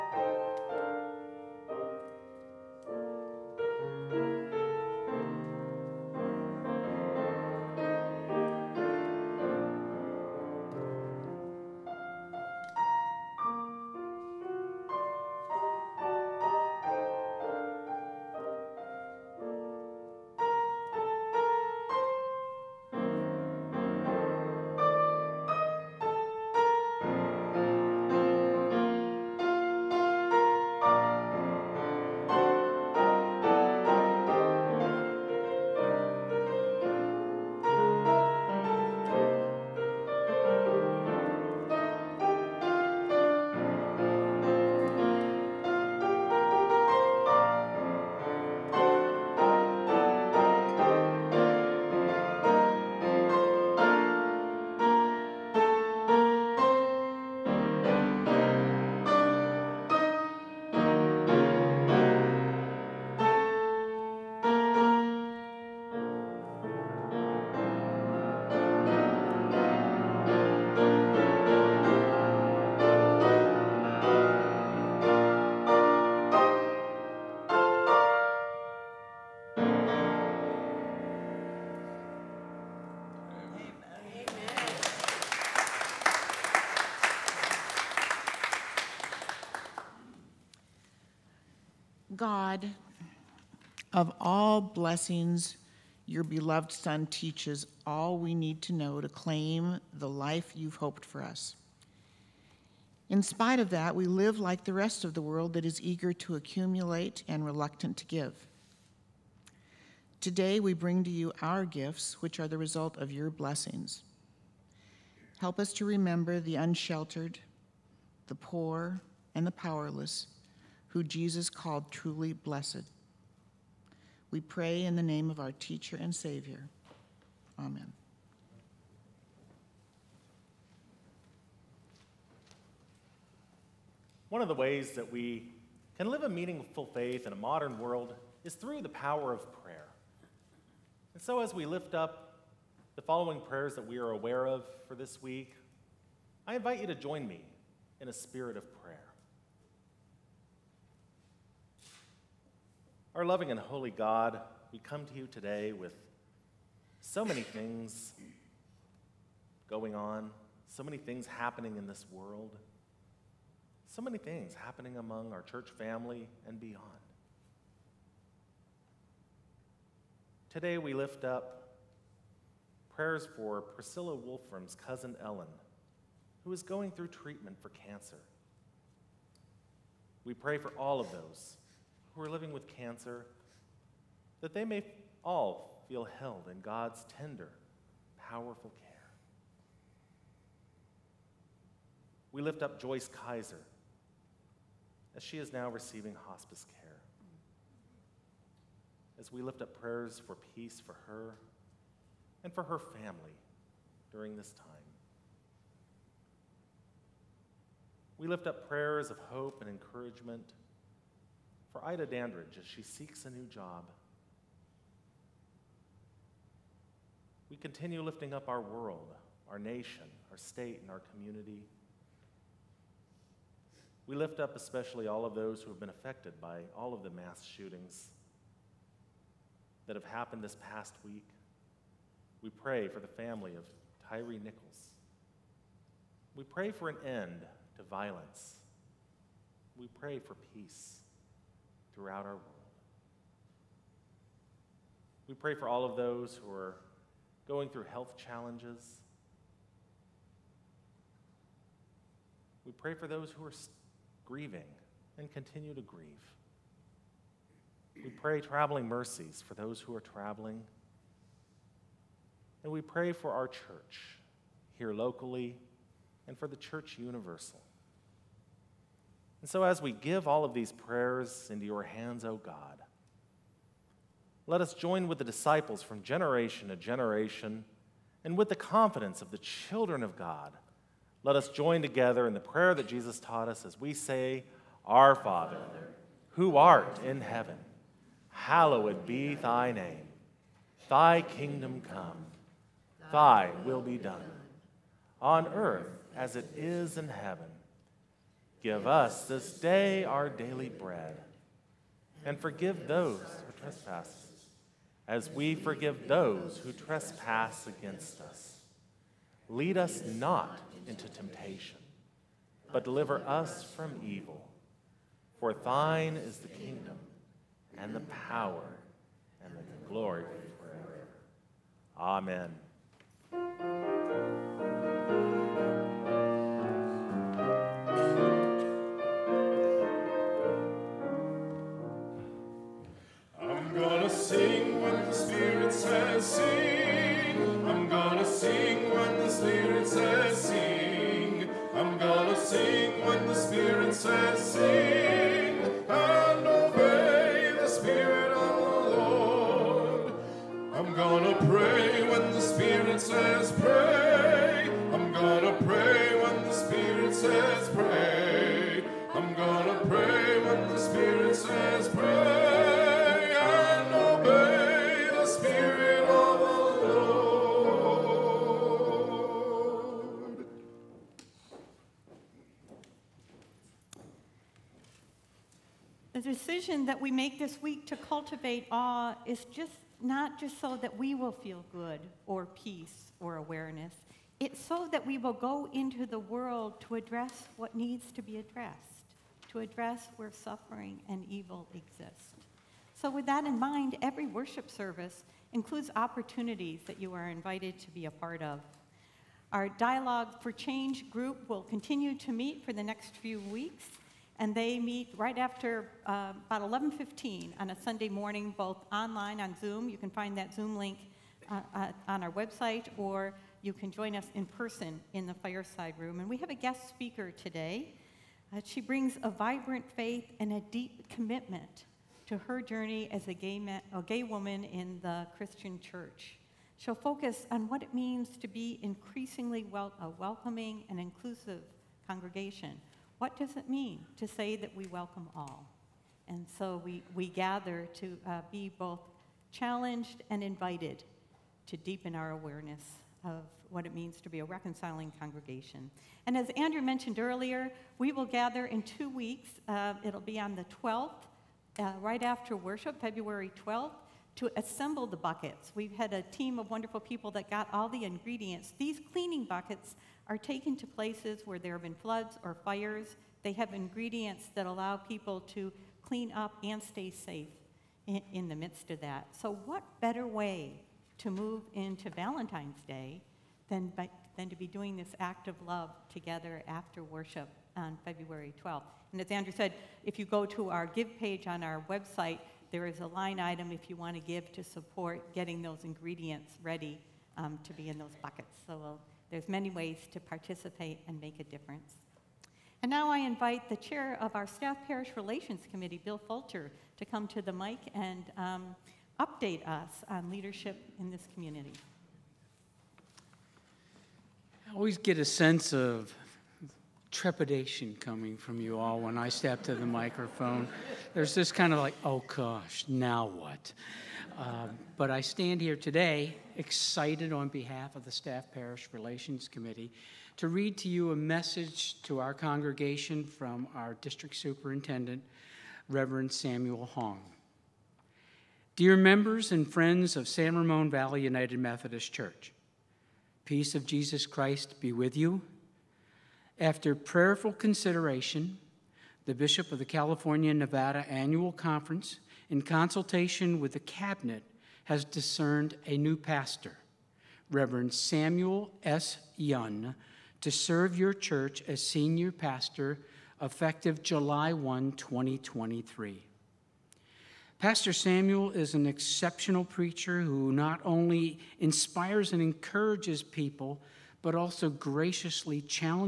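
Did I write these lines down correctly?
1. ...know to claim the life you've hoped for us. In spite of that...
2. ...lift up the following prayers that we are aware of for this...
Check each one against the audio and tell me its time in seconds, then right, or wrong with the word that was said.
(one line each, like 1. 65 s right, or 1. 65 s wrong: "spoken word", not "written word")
1. 98 s right
2. 141 s right.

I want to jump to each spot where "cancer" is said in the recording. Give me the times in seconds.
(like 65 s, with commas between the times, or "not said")
177 s, 182 s.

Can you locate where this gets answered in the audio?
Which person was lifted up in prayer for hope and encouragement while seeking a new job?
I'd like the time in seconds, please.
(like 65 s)
211 s.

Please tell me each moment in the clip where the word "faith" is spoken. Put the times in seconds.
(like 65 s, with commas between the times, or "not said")
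136 s, 419 s.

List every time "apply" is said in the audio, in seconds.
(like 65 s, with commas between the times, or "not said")
not said.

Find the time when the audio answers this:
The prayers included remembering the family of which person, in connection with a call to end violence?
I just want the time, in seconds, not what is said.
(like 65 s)
234 s.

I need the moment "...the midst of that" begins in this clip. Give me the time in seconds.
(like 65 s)
468 s.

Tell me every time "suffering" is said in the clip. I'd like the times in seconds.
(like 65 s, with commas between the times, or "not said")
390 s.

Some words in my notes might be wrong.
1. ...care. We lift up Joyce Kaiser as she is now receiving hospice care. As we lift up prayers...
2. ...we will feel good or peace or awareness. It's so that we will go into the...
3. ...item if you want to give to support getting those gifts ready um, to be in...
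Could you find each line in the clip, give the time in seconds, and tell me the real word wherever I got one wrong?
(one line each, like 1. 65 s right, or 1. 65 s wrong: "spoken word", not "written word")
1. 188 s right
2. 380 s right
3. 483 s wrong: "ingredients", not "gifts".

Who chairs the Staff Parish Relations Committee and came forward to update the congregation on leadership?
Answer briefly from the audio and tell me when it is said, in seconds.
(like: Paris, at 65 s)
Bill Fulcher, at 496 s.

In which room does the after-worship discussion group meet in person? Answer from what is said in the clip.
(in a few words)
fireside room.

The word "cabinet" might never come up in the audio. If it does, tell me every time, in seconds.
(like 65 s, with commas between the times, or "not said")
543 s.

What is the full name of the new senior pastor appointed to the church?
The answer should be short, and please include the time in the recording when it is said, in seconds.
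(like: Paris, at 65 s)
Samuel S. Yun, at 547 s.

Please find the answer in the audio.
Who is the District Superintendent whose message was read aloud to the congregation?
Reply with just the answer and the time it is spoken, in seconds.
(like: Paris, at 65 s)
Samuel Hong, at 525 s.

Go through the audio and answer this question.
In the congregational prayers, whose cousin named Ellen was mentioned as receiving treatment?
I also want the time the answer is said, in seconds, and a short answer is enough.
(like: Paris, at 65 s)
Priscilla Wolfram, at 173 s.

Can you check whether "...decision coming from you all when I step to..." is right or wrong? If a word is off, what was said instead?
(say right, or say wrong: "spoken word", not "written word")
wrong: "trepidation", not "decision".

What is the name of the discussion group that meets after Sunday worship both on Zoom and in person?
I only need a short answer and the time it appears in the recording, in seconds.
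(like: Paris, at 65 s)
Dialogue for Change, at 399 s.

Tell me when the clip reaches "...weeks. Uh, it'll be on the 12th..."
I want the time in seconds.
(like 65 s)
449 s.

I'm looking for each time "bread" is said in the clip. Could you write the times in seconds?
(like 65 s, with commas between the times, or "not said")
300 s.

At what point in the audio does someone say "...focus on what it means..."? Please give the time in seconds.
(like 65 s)
426 s.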